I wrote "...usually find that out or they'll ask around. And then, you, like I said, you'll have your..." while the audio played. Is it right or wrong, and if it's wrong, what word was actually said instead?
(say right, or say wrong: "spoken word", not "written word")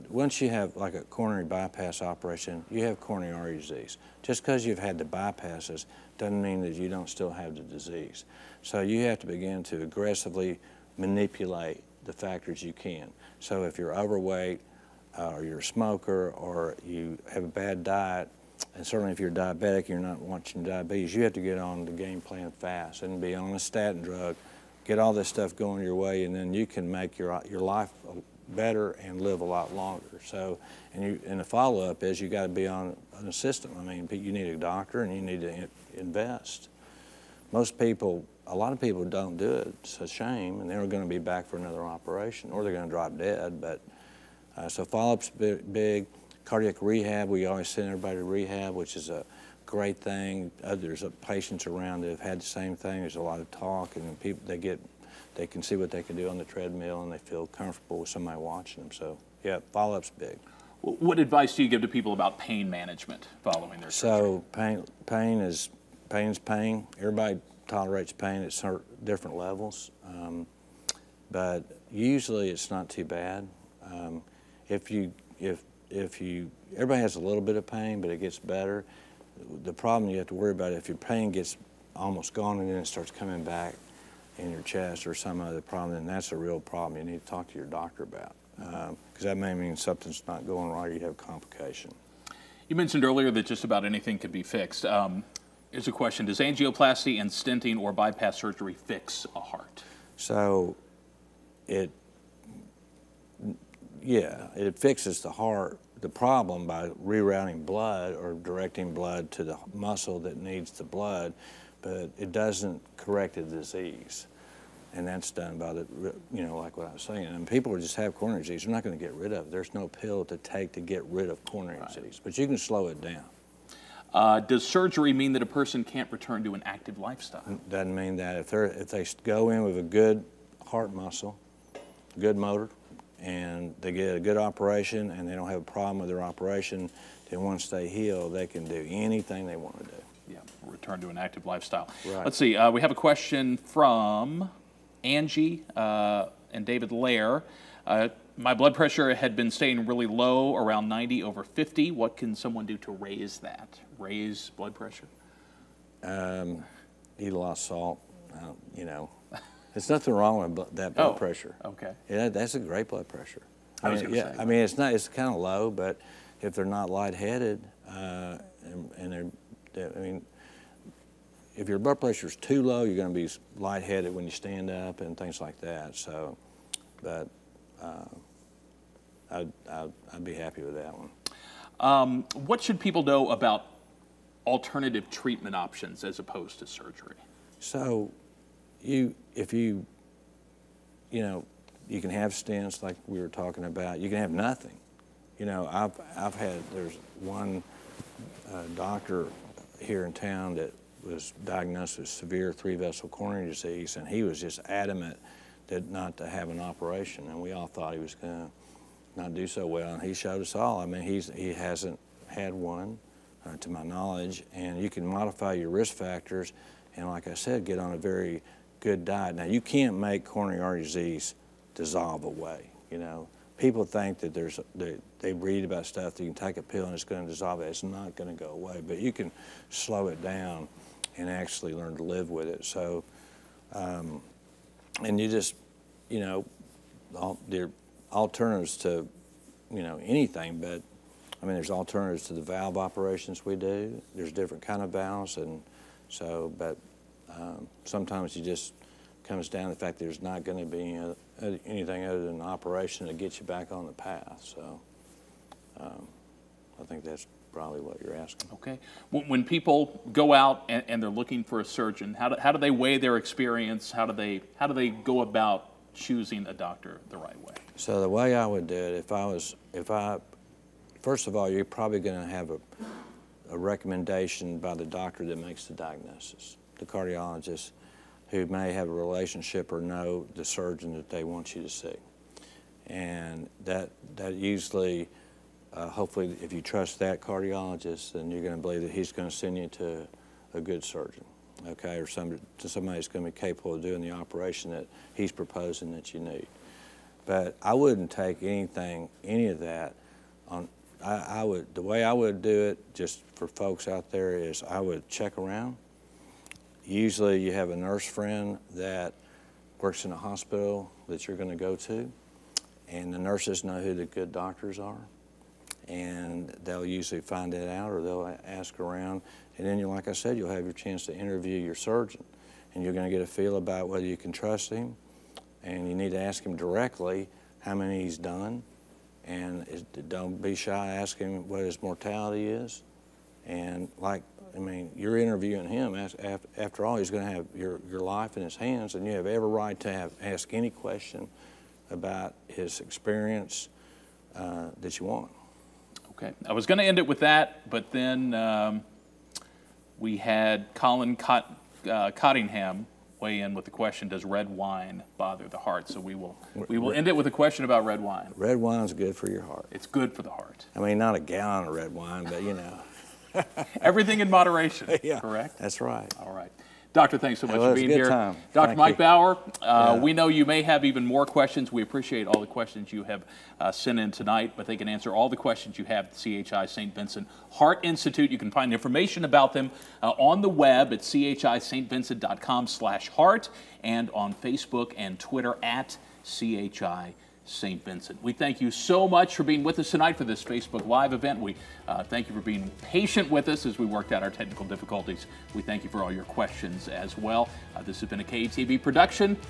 right.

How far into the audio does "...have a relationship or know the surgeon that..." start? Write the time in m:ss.
4:38.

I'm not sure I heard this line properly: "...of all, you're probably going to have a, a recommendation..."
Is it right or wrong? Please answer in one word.
right.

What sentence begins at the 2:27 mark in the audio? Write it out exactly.
Uh, my blood pressure had been staying really low, around 90 over 50.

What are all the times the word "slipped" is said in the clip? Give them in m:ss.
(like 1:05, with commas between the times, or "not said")
not said.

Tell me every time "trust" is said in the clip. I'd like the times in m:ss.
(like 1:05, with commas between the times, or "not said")
4:46, 5:24.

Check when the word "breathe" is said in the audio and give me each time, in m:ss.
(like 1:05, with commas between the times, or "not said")
not said.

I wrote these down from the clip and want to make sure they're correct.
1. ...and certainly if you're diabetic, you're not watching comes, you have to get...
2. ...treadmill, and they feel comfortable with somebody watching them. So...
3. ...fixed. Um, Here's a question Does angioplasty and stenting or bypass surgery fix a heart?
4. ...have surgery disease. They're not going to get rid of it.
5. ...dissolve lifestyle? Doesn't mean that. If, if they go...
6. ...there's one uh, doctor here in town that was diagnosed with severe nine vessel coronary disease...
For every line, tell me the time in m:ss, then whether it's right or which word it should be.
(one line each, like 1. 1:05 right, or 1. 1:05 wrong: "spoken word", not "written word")
1. 0:18 wrong: "diabetes", not "comes"
2. 0:56 right
3. 1:34 right
4. 1:57 wrong: "coronary", not "surgery"
5. 2:06 wrong: "active", not "dissolve"
6. 3:16 wrong: "three", not "nine".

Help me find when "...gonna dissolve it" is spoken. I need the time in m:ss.
3:47.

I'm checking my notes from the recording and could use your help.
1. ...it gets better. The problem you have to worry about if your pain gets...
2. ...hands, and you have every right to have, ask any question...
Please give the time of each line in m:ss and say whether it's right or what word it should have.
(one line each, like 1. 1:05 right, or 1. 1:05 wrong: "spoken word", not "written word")
1. 1:18 right
2. 5:38 right.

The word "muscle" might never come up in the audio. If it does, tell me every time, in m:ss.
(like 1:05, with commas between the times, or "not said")
1:49, 2:10.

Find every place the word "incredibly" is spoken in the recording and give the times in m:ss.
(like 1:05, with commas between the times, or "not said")
not said.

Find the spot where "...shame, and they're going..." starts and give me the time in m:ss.
0:40.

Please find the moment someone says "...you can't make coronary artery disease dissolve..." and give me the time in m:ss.
3:39.